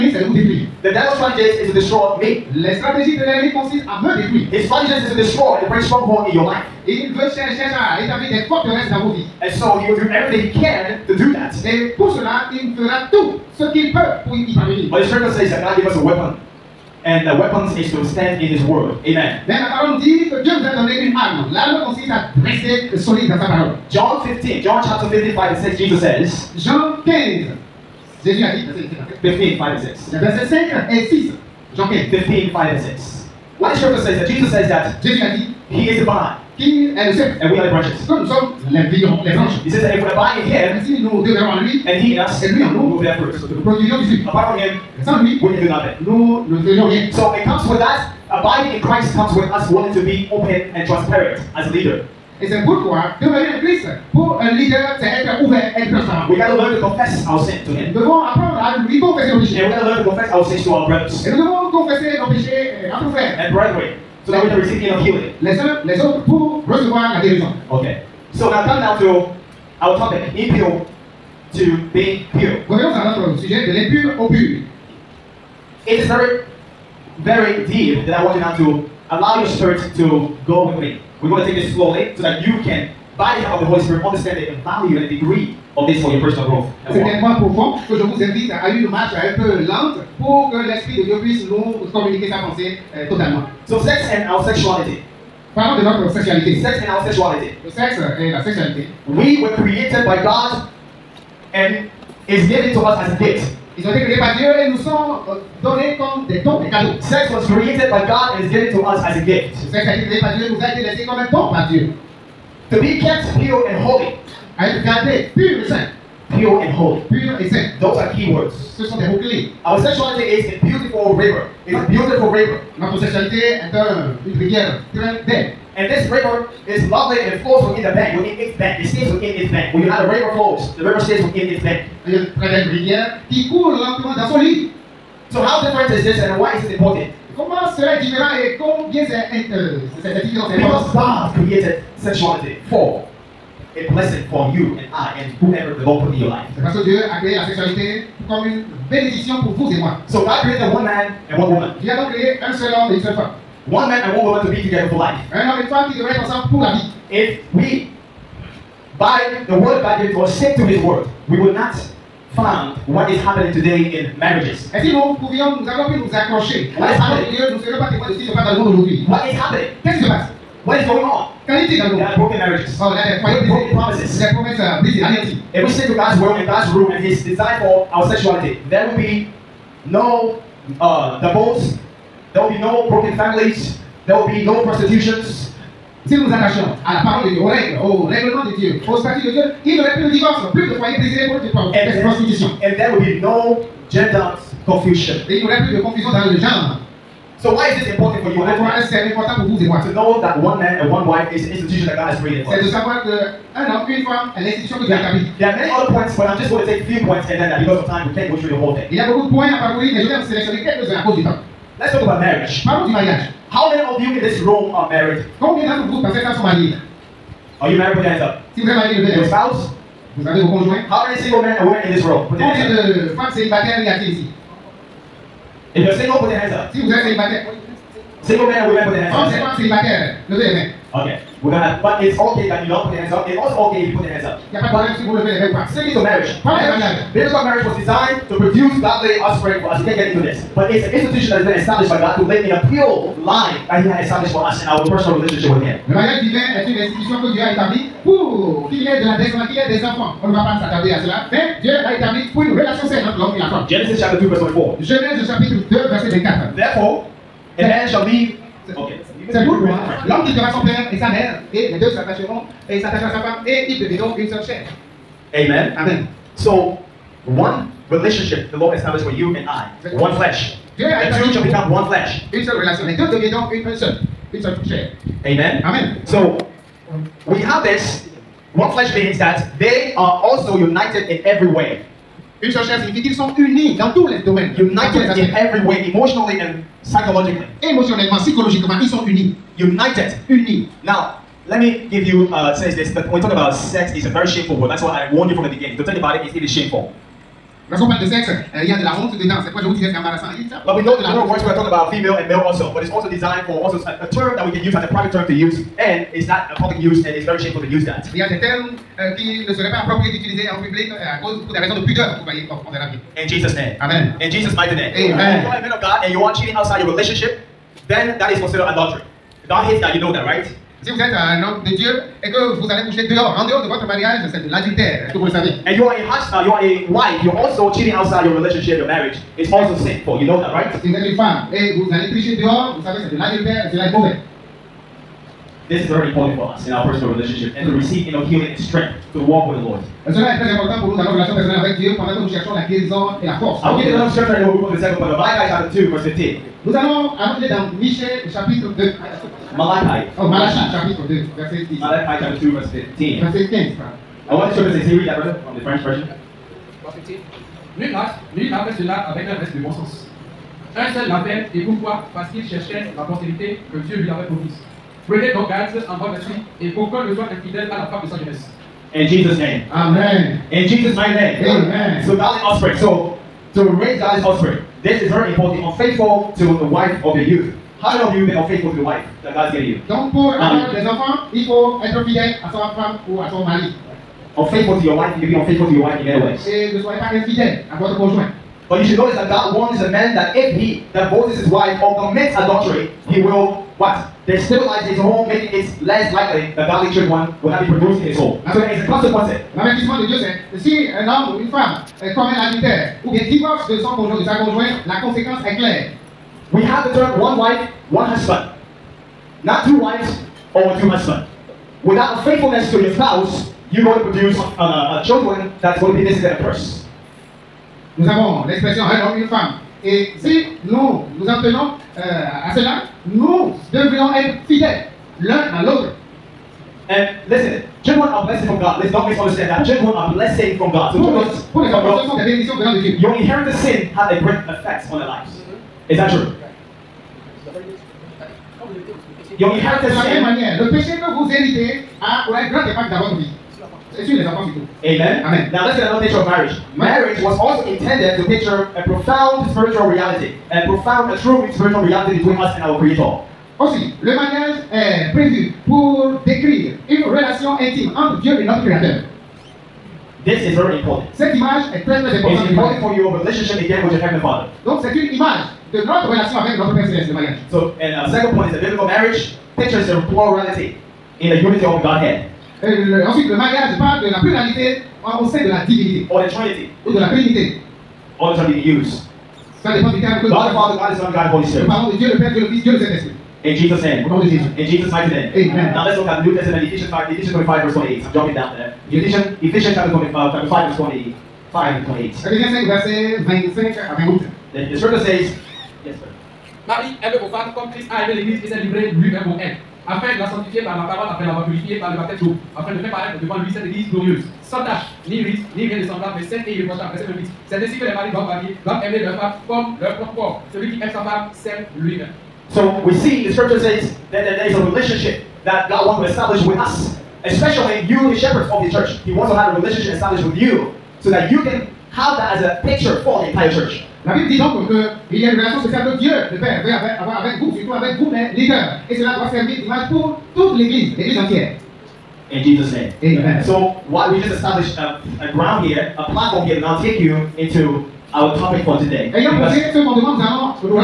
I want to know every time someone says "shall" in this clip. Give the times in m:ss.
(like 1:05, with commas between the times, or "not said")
4:17, 4:31.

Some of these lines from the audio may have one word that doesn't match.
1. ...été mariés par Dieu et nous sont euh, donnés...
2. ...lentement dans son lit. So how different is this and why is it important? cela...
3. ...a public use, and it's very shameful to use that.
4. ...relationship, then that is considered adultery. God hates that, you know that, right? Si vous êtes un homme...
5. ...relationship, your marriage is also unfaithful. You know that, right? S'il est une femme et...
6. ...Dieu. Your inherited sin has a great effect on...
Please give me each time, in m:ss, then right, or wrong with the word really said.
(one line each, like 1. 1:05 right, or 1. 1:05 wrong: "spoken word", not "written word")
1. 1:43 wrong: "créés", not "mariés"
2. 2:13 right
3. 5:06 right
4. 5:16 right
5. 5:28 wrong: "sinful", not "unfaithful"
6. 7:12 right.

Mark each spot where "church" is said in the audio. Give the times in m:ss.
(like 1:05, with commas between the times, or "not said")
8:38, 8:43.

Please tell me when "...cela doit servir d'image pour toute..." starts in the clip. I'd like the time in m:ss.
8:48.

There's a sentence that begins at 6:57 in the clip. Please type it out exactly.
Nous avons l'expression un homme, une femme.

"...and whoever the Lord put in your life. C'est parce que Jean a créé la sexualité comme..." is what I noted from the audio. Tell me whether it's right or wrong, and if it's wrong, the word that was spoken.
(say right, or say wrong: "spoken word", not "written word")
wrong: "Dieu", not "Jean".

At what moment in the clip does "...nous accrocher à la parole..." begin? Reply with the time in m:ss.
2:45.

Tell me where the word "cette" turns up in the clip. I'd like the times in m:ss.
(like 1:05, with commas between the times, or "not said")
3:36, 7:41, 8:23.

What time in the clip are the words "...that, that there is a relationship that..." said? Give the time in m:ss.
8:34.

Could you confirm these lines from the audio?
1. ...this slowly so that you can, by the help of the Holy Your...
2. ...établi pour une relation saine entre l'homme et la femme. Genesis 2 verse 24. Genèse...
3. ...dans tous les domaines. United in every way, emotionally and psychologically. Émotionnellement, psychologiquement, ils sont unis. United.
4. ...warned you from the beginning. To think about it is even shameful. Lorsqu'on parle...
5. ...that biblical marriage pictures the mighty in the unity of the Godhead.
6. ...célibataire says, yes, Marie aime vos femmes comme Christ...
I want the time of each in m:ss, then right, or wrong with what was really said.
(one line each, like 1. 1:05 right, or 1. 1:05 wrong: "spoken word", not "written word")
1. 1:21 wrong: "Spirit", not "Your"
2. 4:11 right
3. 4:43 right
4. 4:55 right
5. 7:48 wrong: "plurality", not "mighty"
6. 8:14 wrong: "scripture", not "célibataire".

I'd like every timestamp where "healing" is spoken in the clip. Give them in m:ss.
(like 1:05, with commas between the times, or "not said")
1:05, 5:38.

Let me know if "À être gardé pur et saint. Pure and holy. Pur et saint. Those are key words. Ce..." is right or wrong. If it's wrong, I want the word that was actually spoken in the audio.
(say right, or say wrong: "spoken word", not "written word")
right.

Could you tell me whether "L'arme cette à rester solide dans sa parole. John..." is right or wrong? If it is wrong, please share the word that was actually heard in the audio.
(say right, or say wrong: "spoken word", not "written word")
wrong: "consiste", not "cette".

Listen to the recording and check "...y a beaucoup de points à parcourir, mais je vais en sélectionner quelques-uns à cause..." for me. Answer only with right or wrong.
right.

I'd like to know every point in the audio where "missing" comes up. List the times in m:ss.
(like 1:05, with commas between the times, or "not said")
6:56.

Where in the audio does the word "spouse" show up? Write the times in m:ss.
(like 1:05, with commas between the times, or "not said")
3:39, 6:52.